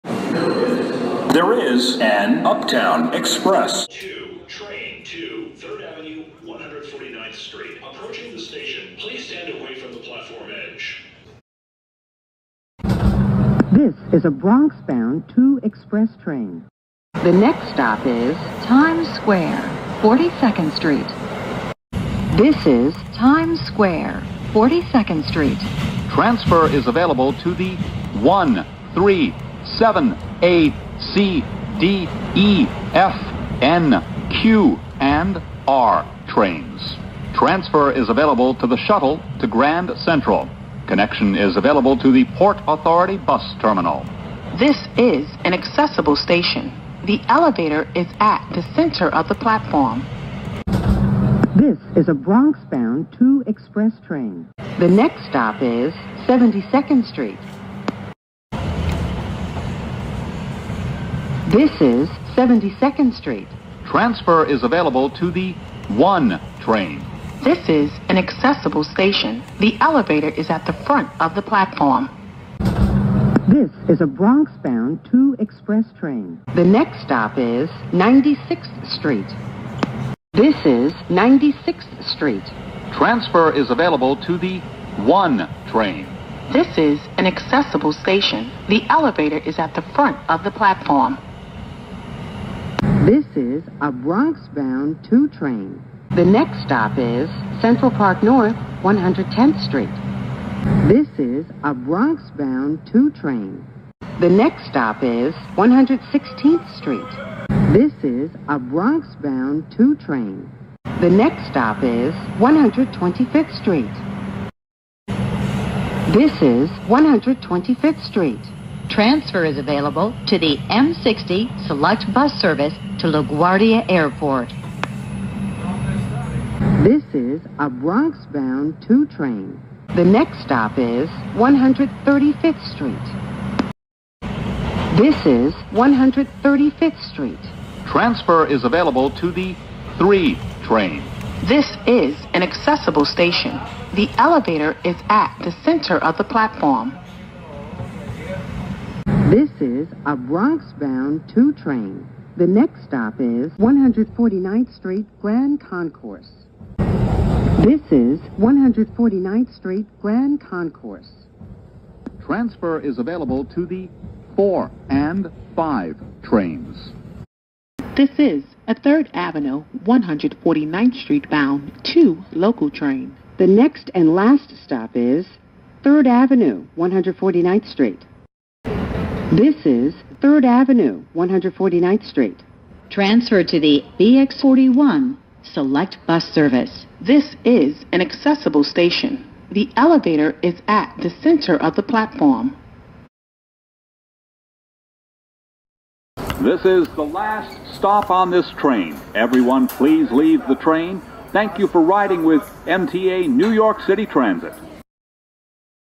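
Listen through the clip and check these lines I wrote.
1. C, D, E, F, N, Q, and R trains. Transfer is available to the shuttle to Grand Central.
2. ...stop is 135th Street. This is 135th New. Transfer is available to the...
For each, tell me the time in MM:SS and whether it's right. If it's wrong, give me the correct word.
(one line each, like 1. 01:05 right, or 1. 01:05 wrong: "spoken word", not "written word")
1. 00:31 right
2. 02:10 wrong: "Street", not "New".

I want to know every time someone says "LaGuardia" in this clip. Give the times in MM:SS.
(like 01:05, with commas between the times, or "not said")
02:03.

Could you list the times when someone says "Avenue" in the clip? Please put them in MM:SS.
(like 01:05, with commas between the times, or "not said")
00:05, 02:49, 02:56, 03:00.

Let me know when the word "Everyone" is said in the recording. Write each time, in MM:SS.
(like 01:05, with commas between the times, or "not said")
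03:19.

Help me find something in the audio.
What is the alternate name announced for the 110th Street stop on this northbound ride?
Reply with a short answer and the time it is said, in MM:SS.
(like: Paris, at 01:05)
Central Park North, at 01:37.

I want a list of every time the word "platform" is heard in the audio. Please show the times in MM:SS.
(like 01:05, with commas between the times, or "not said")
00:09, 00:49, 01:11, 01:30, 02:26, 03:11.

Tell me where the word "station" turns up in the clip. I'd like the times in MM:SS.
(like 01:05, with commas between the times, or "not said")
00:08, 00:46, 01:08, 01:27, 02:23, 03:08.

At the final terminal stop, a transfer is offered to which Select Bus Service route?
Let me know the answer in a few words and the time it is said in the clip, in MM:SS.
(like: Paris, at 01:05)
BX41, at 03:03.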